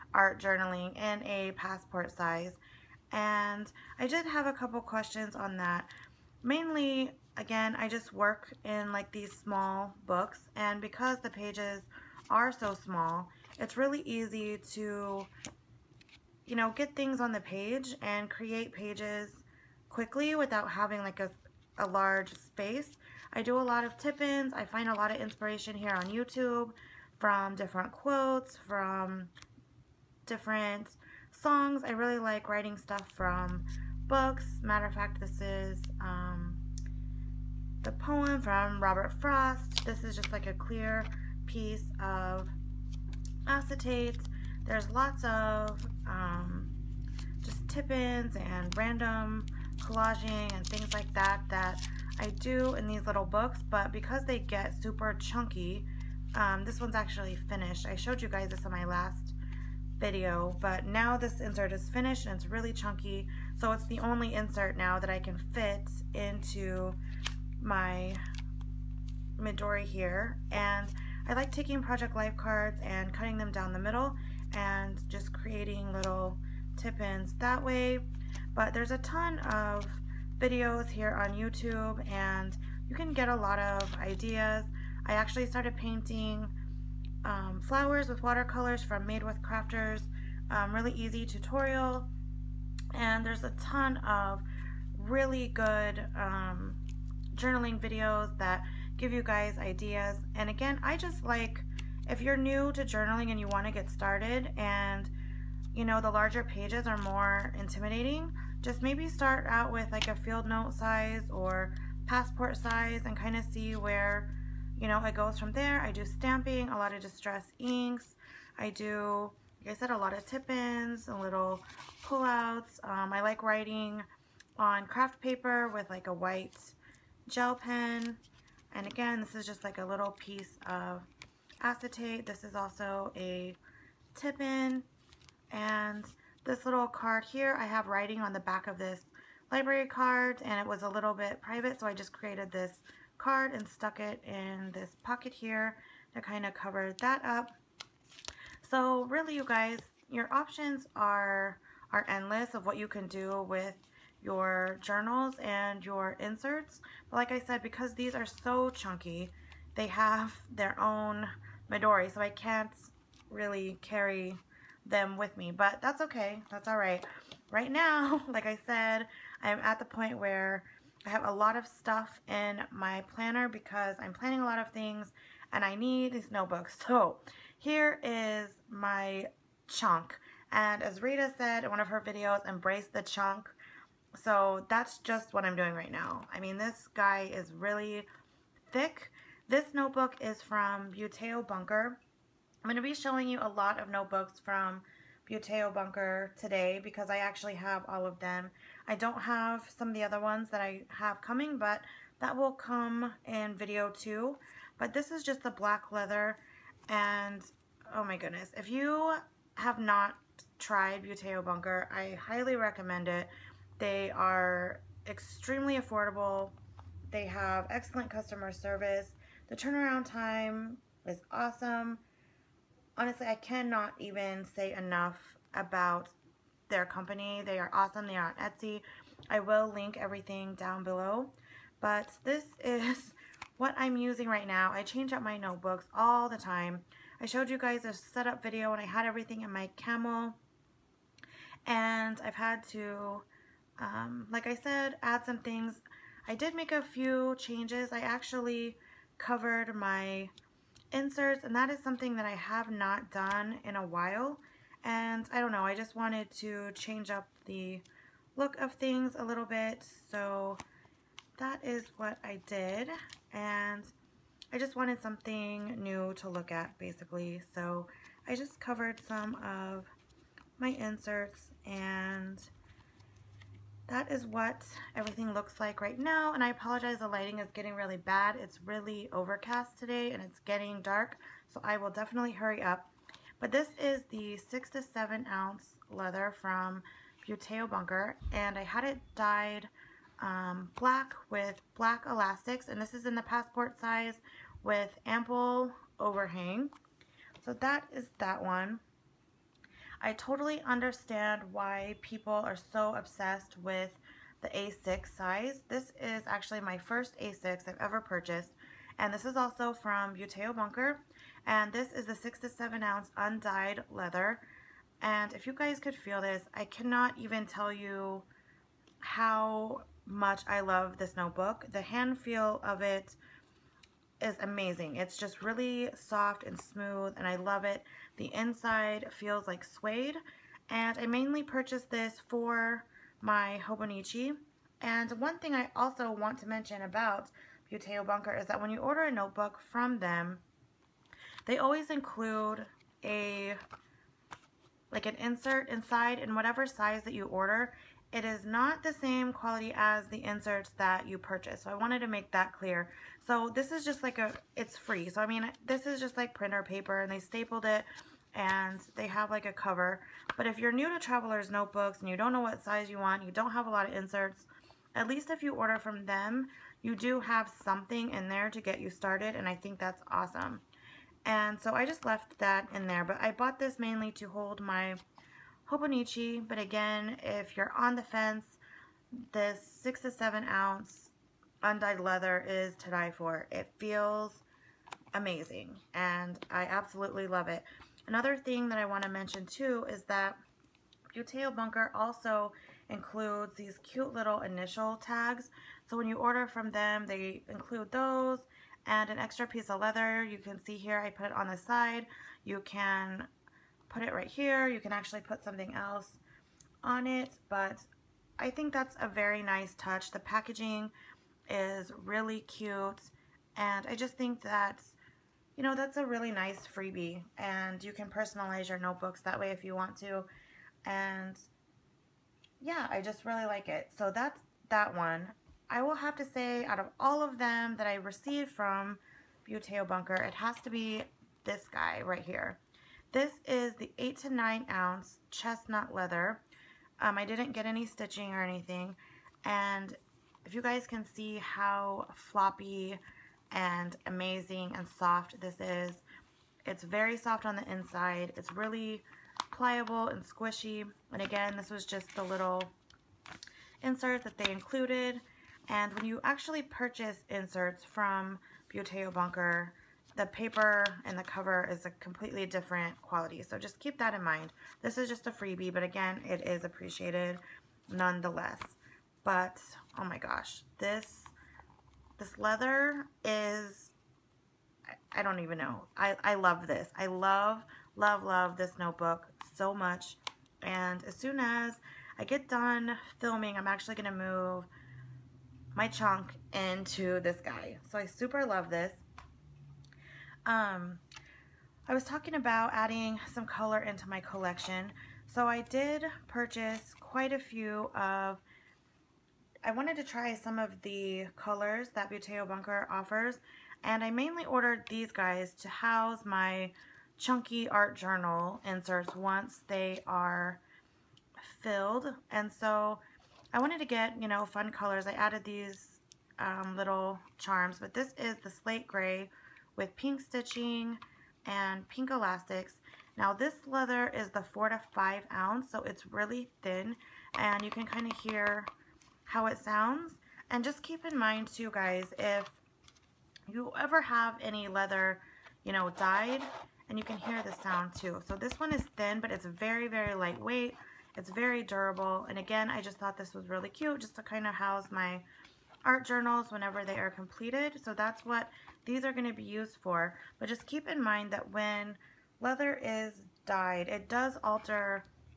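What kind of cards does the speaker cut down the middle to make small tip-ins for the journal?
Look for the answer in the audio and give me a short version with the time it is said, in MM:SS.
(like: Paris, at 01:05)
Project Life cards, at 01:11.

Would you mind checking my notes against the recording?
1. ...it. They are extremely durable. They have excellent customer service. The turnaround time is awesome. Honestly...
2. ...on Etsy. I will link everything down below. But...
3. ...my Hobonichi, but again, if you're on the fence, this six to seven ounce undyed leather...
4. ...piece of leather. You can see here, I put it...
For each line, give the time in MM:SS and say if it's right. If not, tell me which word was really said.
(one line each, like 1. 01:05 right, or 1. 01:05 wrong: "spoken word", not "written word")
1. 03:33 wrong: "affordable", not "durable"
2. 03:48 right
3. 06:14 right
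4. 06:39 right.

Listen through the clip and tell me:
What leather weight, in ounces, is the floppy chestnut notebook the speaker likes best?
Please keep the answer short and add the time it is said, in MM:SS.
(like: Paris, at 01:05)
8 to 9 ounce, at 07:13.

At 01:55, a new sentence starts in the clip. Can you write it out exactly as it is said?
I do stamping, a lot of distress inks.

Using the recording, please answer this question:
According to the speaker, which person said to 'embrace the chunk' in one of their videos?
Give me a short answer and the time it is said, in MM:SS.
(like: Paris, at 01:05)
Rita, at 03:01.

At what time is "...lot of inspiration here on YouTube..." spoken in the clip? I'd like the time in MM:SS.
00:24.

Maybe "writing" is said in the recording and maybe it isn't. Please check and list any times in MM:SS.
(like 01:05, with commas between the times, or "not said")
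00:32, 02:03, 02:17.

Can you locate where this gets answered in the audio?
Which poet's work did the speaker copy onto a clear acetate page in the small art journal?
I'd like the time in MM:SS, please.
00:38.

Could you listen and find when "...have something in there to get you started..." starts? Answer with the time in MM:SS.
06:07.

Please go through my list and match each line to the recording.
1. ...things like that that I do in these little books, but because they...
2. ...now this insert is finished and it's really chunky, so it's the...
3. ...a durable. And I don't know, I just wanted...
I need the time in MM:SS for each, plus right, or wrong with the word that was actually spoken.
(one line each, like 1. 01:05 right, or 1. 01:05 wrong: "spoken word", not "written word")
1. 00:50 right
2. 01:00 right
3. 04:13 wrong: "while", not "durable".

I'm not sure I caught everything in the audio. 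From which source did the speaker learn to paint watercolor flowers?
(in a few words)
Made With Crafters.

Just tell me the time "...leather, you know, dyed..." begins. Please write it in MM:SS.
08:54.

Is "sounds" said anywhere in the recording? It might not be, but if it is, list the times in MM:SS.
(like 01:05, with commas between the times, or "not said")
08:49, 08:57.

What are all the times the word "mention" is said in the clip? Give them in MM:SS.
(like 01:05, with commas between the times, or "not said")
05:36, 06:29.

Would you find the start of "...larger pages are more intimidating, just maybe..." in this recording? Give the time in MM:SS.
01:46.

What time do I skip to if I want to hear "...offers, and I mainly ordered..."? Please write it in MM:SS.
08:22.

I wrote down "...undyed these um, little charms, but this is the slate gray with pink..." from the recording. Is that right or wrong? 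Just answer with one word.
wrong.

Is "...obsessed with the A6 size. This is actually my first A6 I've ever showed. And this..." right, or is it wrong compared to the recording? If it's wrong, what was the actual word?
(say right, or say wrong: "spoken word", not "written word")
wrong: "purchased", not "showed".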